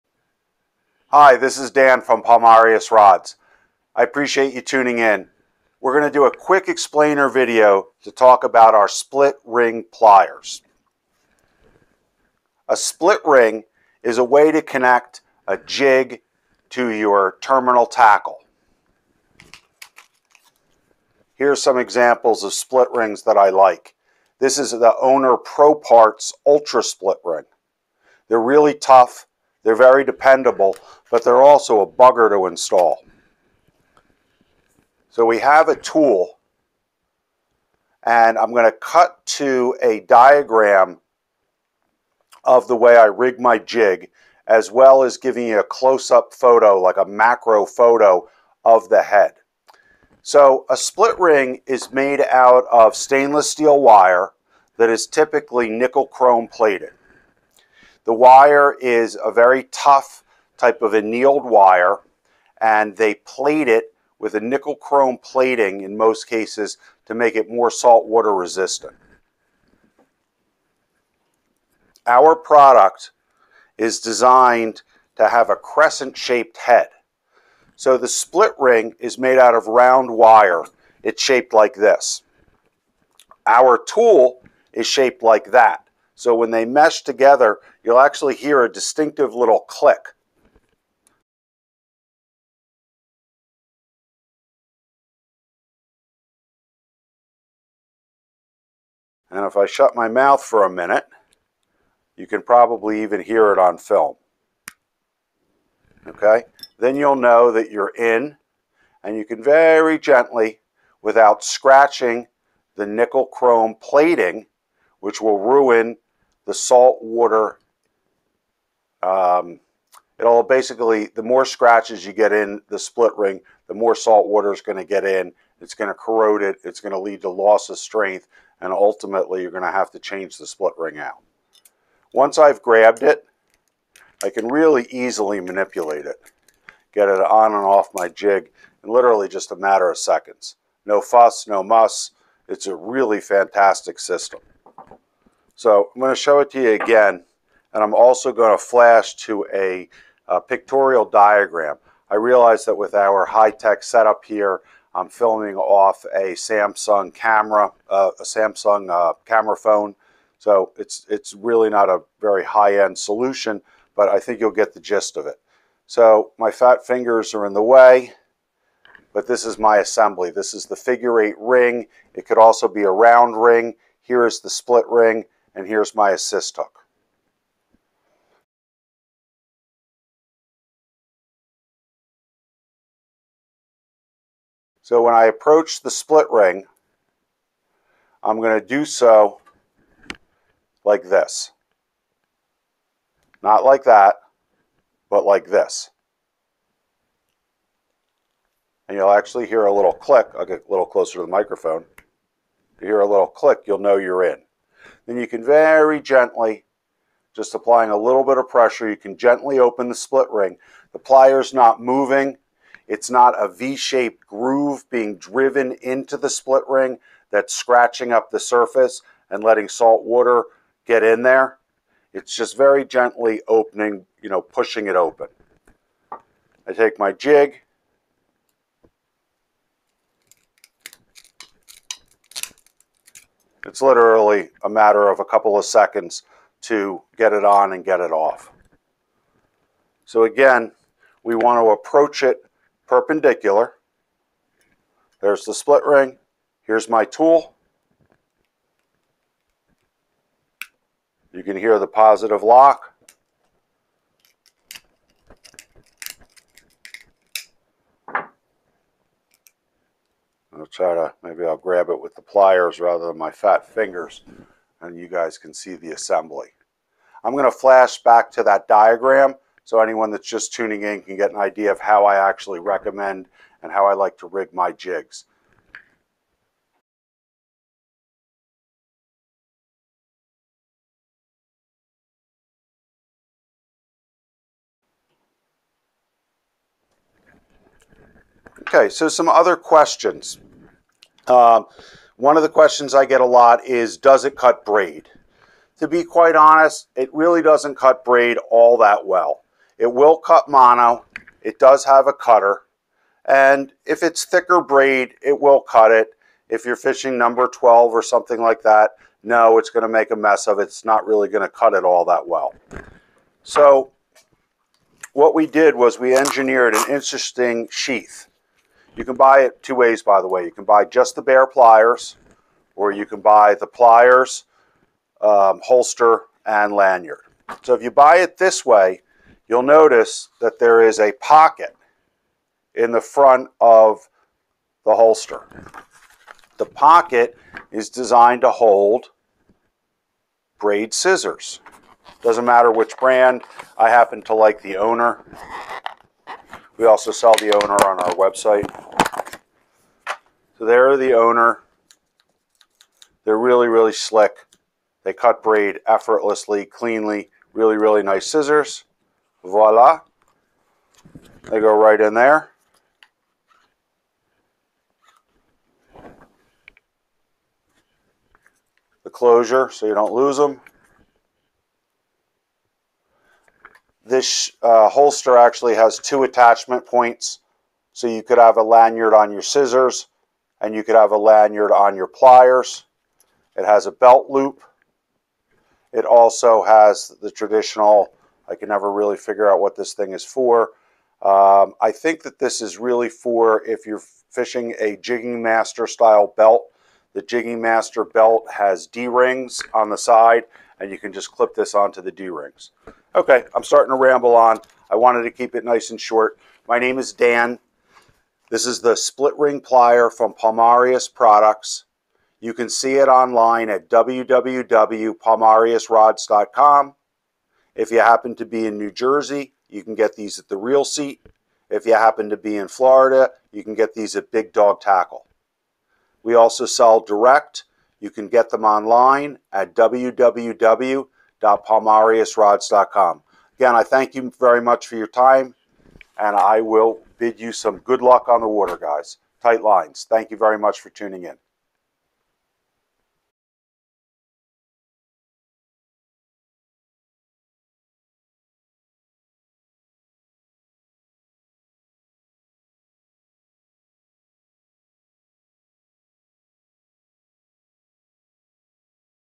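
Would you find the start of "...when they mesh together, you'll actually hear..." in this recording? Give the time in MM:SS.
01:26.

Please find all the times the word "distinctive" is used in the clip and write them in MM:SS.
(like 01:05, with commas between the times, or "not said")
01:28.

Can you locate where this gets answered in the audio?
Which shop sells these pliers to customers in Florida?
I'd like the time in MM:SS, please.
07:04.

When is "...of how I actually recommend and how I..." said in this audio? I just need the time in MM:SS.
04:31.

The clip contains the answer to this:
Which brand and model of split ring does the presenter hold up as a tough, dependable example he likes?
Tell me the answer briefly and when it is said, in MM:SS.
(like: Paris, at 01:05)
Owner Pro Parts Ultra Split Ring, at 00:25.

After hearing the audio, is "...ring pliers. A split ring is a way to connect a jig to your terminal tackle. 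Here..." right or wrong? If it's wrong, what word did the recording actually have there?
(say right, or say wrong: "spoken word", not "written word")
right.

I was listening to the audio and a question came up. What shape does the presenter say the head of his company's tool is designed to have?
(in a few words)
Crescent shaped.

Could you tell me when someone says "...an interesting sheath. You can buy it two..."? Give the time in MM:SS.
05:16.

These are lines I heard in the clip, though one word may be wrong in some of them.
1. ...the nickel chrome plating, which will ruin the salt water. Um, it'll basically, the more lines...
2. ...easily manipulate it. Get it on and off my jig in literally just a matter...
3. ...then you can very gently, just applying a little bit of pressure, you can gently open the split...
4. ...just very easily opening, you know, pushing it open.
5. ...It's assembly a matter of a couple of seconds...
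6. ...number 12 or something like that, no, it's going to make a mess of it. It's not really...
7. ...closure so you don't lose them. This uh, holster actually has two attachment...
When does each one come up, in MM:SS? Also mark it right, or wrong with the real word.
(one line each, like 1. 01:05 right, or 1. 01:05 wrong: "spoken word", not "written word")
1. 01:52 wrong: "scratches", not "lines"
2. 02:14 right
3. 03:25 right
4. 03:42 wrong: "gently", not "easily"
5. 03:53 wrong: "literally", not "assembly"
6. 05:07 right
7. 06:09 right.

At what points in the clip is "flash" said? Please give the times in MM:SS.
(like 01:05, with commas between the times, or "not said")
02:28, 04:27.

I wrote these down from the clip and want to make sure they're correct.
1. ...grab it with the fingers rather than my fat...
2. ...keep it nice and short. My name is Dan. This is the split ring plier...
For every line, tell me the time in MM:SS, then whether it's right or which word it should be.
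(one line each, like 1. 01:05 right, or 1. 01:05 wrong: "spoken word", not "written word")
1. 04:21 wrong: "pliers", not "fingers"
2. 06:45 right.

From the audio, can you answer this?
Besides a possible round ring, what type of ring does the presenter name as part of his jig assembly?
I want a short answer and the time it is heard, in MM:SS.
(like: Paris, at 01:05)
Figure eight ring, at 02:50.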